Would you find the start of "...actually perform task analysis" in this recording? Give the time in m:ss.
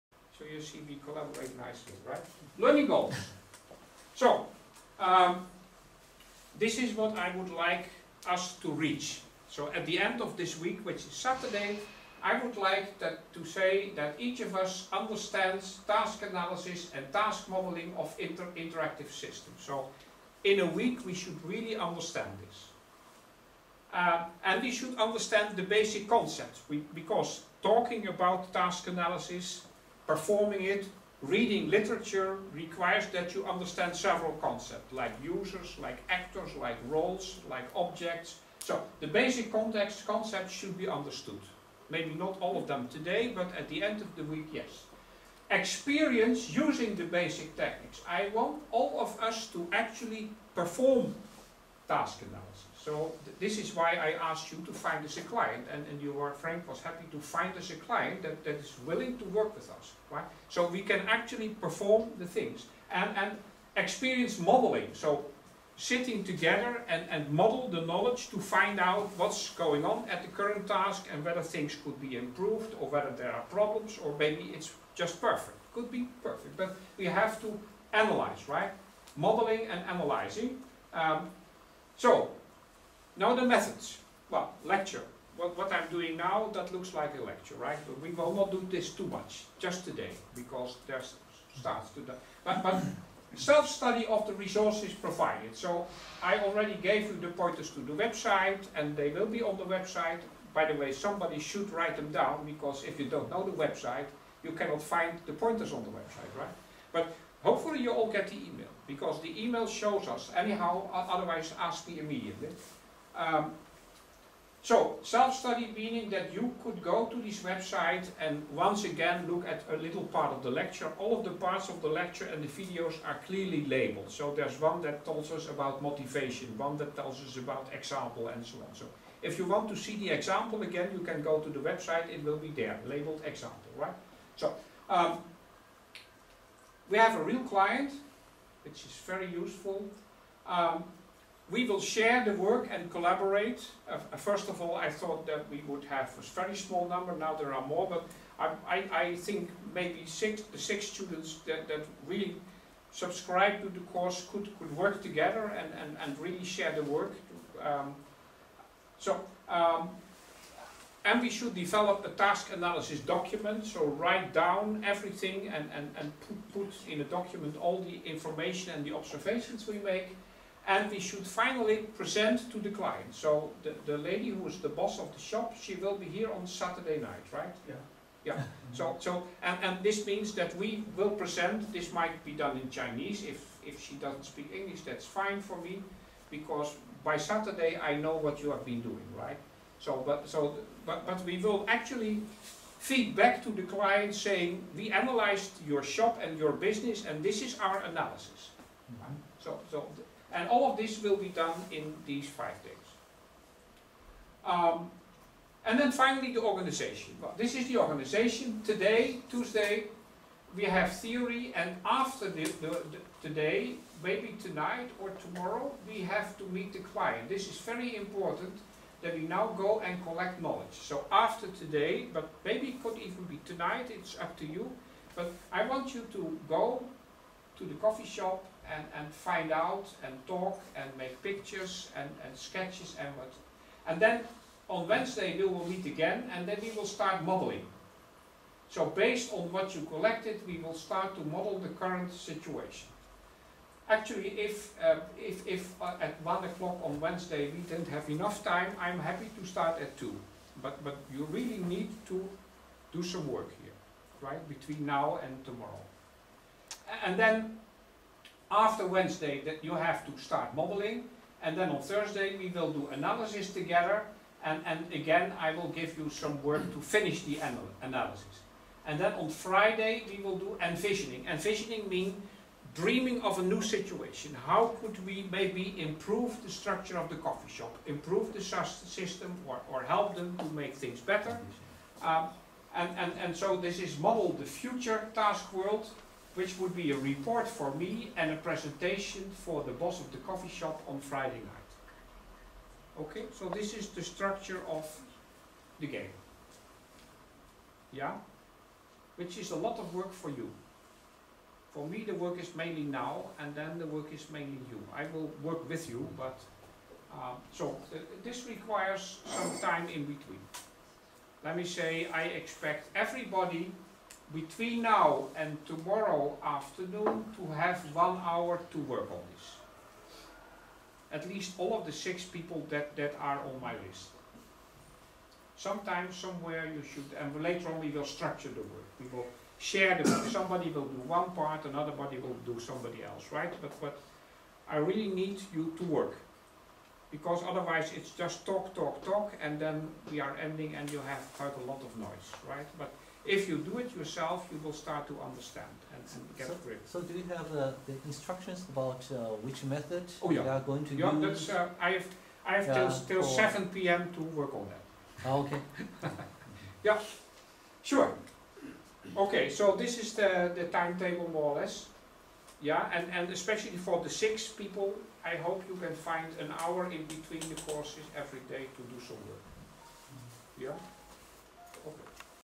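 0:49.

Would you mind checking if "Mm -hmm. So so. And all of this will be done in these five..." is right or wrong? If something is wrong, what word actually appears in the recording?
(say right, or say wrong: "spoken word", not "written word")
right.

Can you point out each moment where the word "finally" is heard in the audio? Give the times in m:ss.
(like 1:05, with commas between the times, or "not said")
2:51, 3:25.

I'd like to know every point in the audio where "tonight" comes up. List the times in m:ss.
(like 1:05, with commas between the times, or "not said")
3:34, 3:43.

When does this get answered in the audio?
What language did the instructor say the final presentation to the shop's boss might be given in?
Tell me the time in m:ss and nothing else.
3:02.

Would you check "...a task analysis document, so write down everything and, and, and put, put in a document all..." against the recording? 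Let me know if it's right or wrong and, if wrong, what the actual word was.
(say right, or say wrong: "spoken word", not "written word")
right.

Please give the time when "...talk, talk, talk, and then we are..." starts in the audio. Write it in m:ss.
5:38.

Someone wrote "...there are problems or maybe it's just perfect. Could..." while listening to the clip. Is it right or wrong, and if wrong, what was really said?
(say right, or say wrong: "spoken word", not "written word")
right.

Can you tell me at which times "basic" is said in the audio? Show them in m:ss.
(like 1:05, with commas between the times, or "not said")
0:25, 0:39, 0:47.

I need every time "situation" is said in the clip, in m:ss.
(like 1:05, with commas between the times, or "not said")
4:02, 4:33.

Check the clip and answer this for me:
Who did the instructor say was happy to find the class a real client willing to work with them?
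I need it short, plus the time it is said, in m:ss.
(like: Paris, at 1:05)
Frank, at 0:56.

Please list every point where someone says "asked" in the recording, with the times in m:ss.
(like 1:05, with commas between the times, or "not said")
0:54.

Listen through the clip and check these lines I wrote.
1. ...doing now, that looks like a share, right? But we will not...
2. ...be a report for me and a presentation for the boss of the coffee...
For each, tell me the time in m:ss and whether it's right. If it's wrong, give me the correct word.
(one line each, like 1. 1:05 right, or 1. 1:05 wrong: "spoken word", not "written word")
1. 1:25 wrong: "lecture", not "share"
2. 4:46 right.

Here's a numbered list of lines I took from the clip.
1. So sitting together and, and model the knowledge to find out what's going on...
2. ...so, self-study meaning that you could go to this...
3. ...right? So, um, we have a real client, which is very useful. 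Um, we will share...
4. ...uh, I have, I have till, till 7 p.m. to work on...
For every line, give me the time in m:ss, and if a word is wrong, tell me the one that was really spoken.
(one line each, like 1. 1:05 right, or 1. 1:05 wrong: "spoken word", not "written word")
1. 1:04 right
2. 1:54 right
3. 2:13 right
4. 5:51 right.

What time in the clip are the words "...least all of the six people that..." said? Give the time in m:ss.
5:21.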